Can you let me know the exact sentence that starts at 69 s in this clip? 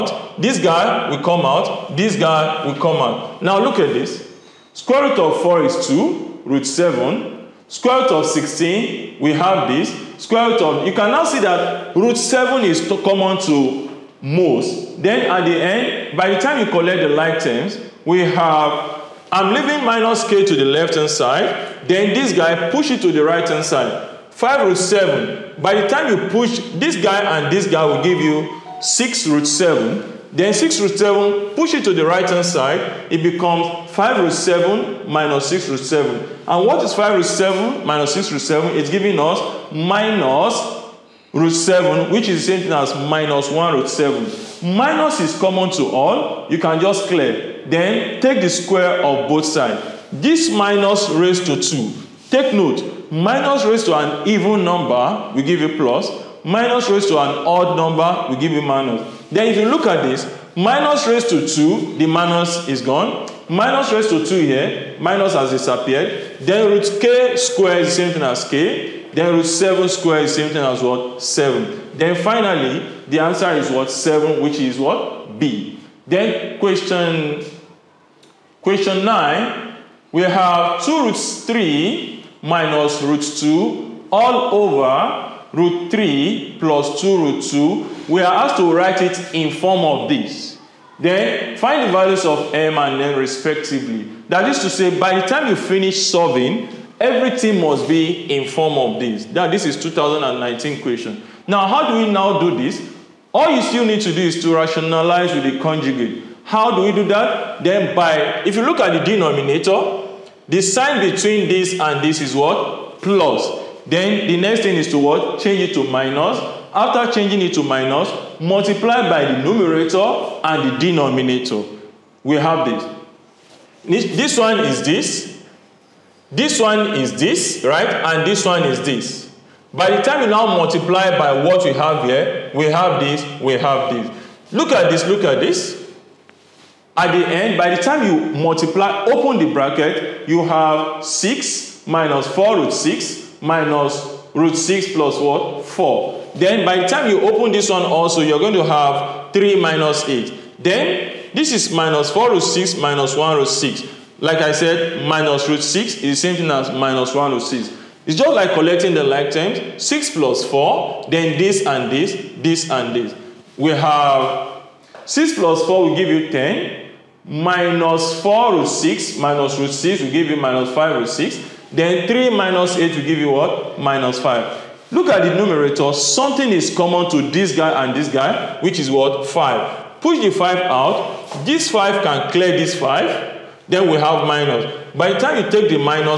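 Then root 7 squared is the same thing as what?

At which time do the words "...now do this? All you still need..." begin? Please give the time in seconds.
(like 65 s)
102 s.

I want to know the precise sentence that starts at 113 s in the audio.
Then the next thing is to what?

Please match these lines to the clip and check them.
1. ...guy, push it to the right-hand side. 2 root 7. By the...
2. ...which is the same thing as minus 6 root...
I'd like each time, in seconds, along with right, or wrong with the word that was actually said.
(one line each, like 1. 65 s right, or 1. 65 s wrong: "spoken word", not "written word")
1. 22 s wrong: "5", not "2"
2. 42 s wrong: "1", not "6".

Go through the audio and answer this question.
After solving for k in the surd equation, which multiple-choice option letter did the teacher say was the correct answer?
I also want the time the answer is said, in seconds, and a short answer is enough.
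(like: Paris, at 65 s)
B, at 75 s.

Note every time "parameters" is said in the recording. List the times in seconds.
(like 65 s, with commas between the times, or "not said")
not said.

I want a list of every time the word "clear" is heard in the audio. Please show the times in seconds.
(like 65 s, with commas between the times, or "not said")
47 s, 182 s.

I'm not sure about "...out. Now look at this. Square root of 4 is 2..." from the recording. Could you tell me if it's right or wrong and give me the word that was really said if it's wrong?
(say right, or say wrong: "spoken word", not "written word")
right.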